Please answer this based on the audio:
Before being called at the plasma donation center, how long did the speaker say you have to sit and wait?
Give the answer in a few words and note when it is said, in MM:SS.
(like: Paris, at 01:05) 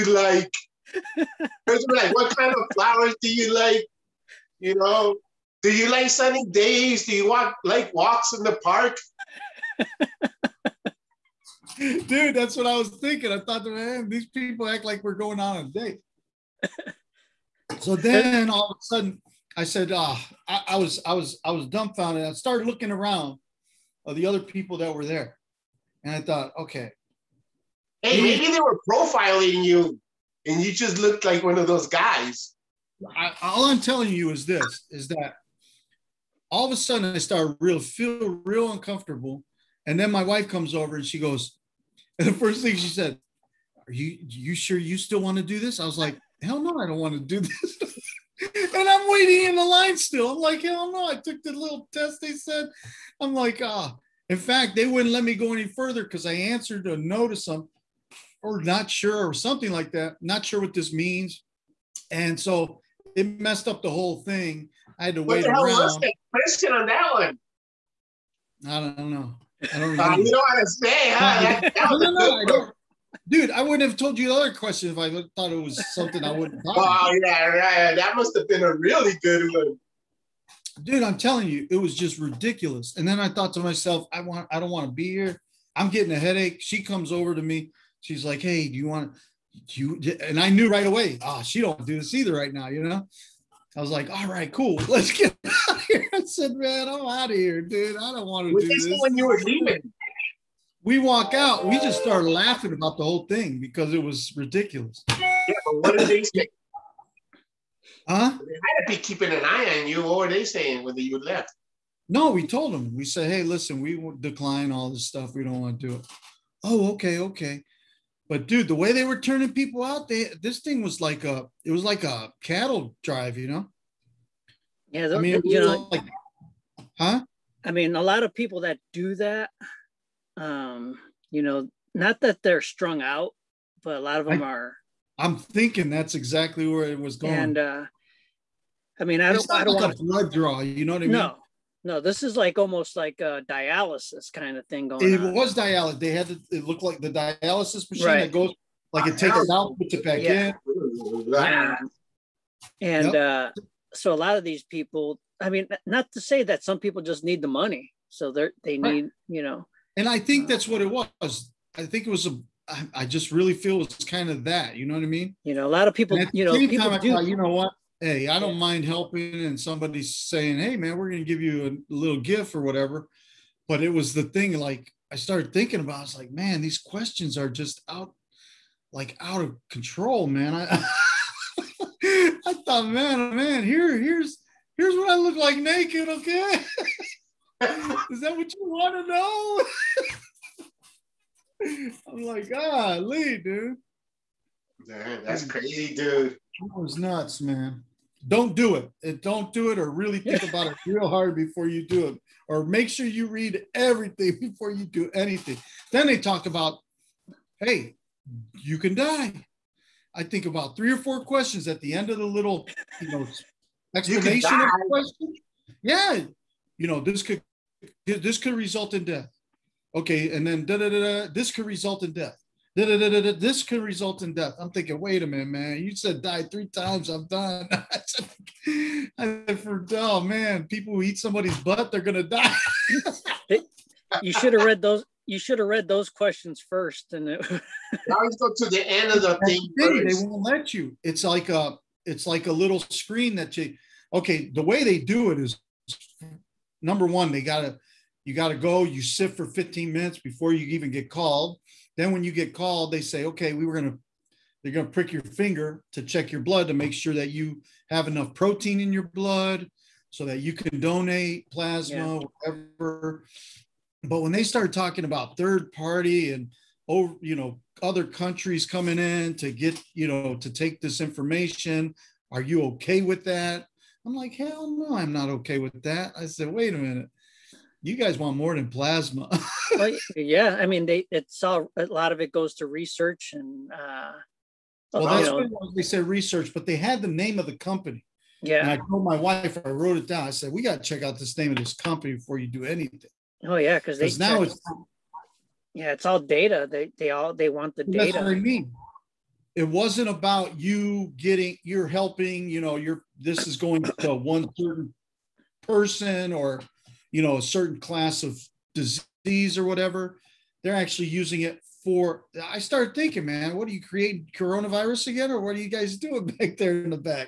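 15 minutes, at 04:09.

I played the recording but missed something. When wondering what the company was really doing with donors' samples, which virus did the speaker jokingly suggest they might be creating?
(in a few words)
coronavirus.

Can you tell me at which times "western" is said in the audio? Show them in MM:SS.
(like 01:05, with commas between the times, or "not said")
not said.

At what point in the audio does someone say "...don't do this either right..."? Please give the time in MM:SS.
01:31.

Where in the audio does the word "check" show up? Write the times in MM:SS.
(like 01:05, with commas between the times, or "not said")
04:16, 04:50.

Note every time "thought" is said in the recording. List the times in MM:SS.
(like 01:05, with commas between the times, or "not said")
00:13, 00:26, 01:15, 01:23, 03:02.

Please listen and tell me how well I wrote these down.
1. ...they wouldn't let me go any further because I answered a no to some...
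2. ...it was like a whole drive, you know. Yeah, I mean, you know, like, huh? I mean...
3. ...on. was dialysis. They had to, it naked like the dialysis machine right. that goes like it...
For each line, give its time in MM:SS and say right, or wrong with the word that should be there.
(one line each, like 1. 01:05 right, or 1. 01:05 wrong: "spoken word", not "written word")
1. 00:54 right
2. 02:01 wrong: "cattle", not "whole"
3. 02:25 wrong: "looked", not "naked".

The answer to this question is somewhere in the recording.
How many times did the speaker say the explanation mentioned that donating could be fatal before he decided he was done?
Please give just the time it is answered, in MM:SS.
03:46.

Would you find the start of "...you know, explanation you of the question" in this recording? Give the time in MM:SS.
03:33.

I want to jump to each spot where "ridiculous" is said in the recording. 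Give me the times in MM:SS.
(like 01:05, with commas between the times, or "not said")
01:22, 01:44.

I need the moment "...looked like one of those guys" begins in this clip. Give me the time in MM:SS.
00:30.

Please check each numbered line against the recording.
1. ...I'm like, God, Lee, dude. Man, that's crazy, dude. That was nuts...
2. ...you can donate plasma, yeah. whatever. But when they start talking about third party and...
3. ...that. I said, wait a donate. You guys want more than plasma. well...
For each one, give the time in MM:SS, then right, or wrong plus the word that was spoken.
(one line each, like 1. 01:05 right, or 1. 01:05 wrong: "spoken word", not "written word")
1. 03:12 right
2. 04:20 right
3. 04:35 wrong: "minute", not "donate".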